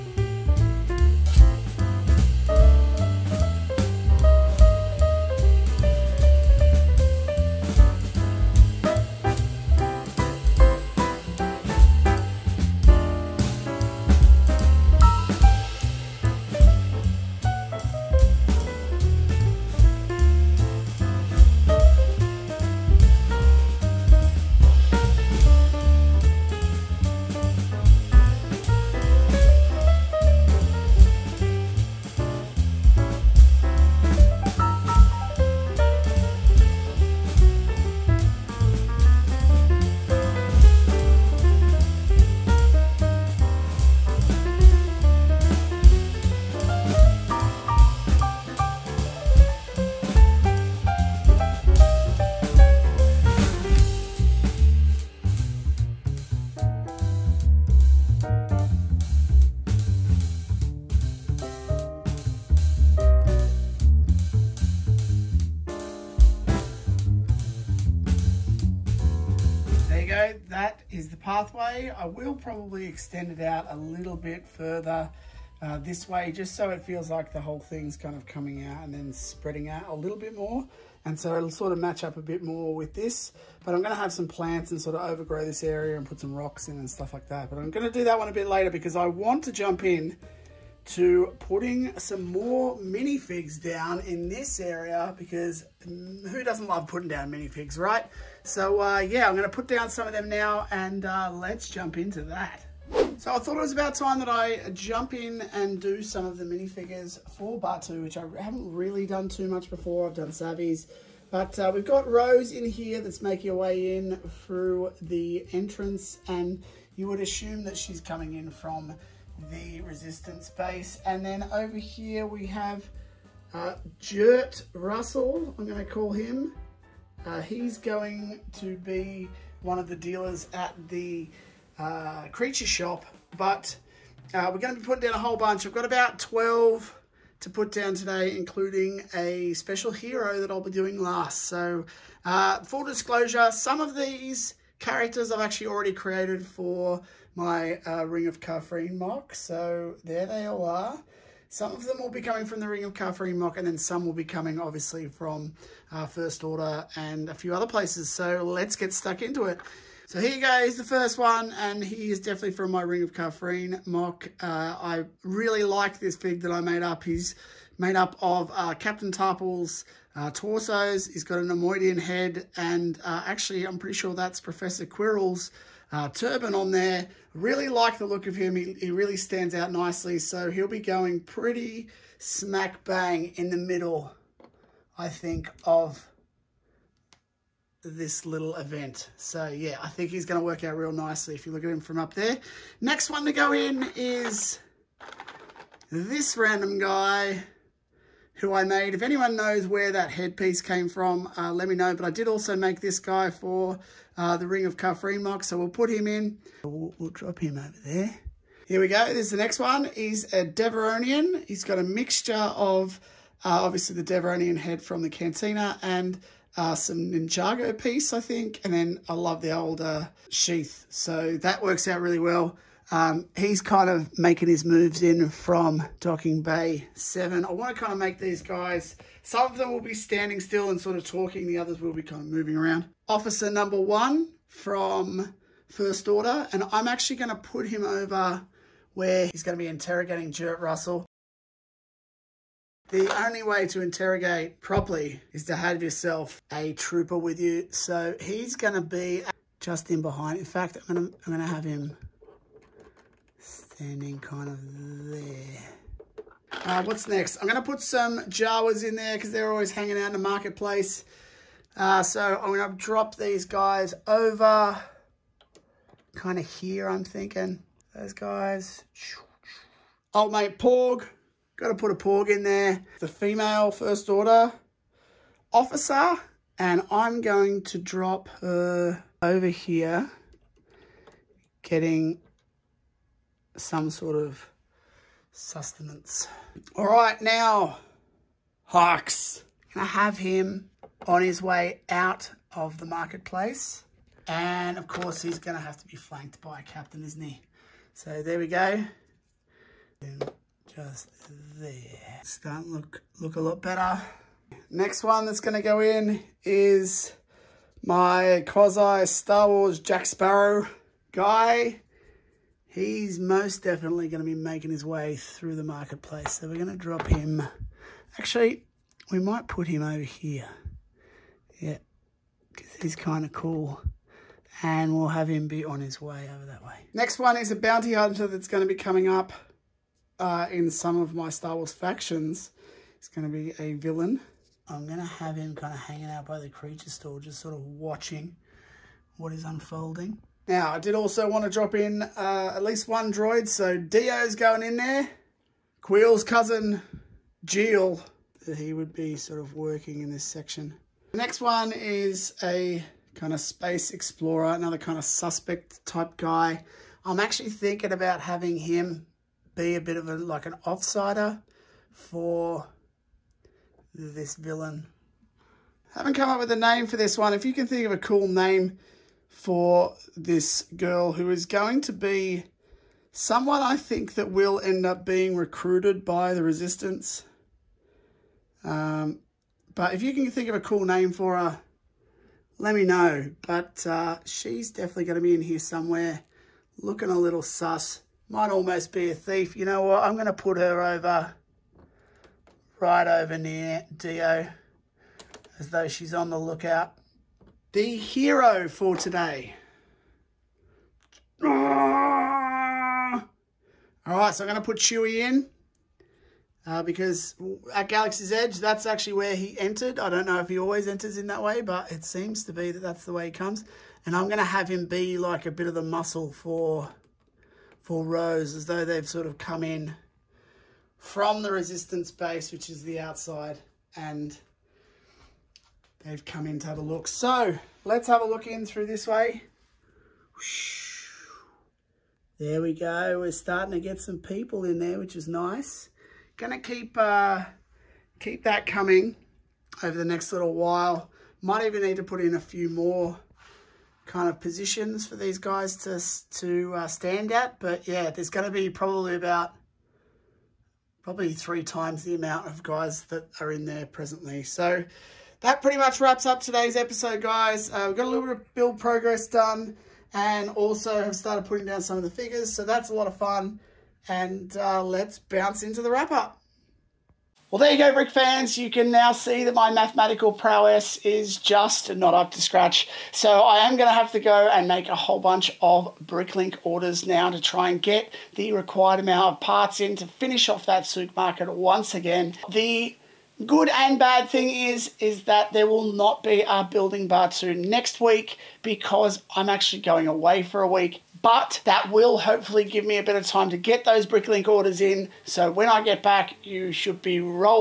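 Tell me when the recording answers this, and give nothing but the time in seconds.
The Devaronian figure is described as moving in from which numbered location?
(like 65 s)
225 s.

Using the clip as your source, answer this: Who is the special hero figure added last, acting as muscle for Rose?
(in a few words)
Chewie.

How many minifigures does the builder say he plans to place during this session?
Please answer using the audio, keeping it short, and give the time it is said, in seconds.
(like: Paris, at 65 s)
12, at 136 s.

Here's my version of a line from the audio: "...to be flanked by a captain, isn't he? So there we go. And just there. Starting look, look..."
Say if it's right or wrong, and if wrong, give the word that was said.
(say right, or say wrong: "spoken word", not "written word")
right.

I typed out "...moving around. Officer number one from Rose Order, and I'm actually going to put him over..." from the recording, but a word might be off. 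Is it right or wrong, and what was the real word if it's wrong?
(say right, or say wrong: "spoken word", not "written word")
wrong: "First", not "Rose".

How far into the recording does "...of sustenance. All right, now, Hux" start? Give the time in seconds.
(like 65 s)
284 s.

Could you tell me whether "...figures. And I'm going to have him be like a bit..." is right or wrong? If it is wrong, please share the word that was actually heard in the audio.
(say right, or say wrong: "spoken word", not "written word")
wrong: "comes", not "figures".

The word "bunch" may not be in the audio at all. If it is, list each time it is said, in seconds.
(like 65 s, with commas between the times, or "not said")
135 s, 475 s.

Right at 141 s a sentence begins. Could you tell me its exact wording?
So, uh, full disclosure, some of these characters I've actually already created for my uh, Ring of Kafrene MOC.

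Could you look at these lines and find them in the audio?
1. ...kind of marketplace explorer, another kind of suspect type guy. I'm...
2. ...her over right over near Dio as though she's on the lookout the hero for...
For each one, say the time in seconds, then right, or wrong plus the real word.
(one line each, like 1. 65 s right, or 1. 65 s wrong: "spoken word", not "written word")
1. 353 s wrong: "space", not "marketplace"
2. 390 s right.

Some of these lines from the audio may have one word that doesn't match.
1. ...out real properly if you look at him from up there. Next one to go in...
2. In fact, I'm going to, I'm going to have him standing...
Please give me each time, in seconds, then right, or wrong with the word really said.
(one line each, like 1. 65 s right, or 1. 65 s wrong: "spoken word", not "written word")
1. 190 s wrong: "nicely", not "properly"
2. 250 s right.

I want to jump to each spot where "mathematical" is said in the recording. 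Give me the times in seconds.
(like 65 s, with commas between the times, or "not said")
469 s.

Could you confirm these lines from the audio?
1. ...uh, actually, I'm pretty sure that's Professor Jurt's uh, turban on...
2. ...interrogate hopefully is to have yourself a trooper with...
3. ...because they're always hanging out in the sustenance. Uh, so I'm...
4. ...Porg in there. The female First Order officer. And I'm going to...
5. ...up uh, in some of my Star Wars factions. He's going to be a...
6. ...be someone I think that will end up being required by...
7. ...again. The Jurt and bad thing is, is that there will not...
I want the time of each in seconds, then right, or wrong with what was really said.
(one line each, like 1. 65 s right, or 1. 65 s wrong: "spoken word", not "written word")
1. 173 s wrong: "Quirrell", not "Jurt"
2. 243 s wrong: "properly", not "hopefully"
3. 259 s wrong: "marketplace", not "sustenance"
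4. 271 s right
5. 329 s right
6. 371 s wrong: "recruited", not "required"
7. 481 s wrong: "Good", not "Jurt".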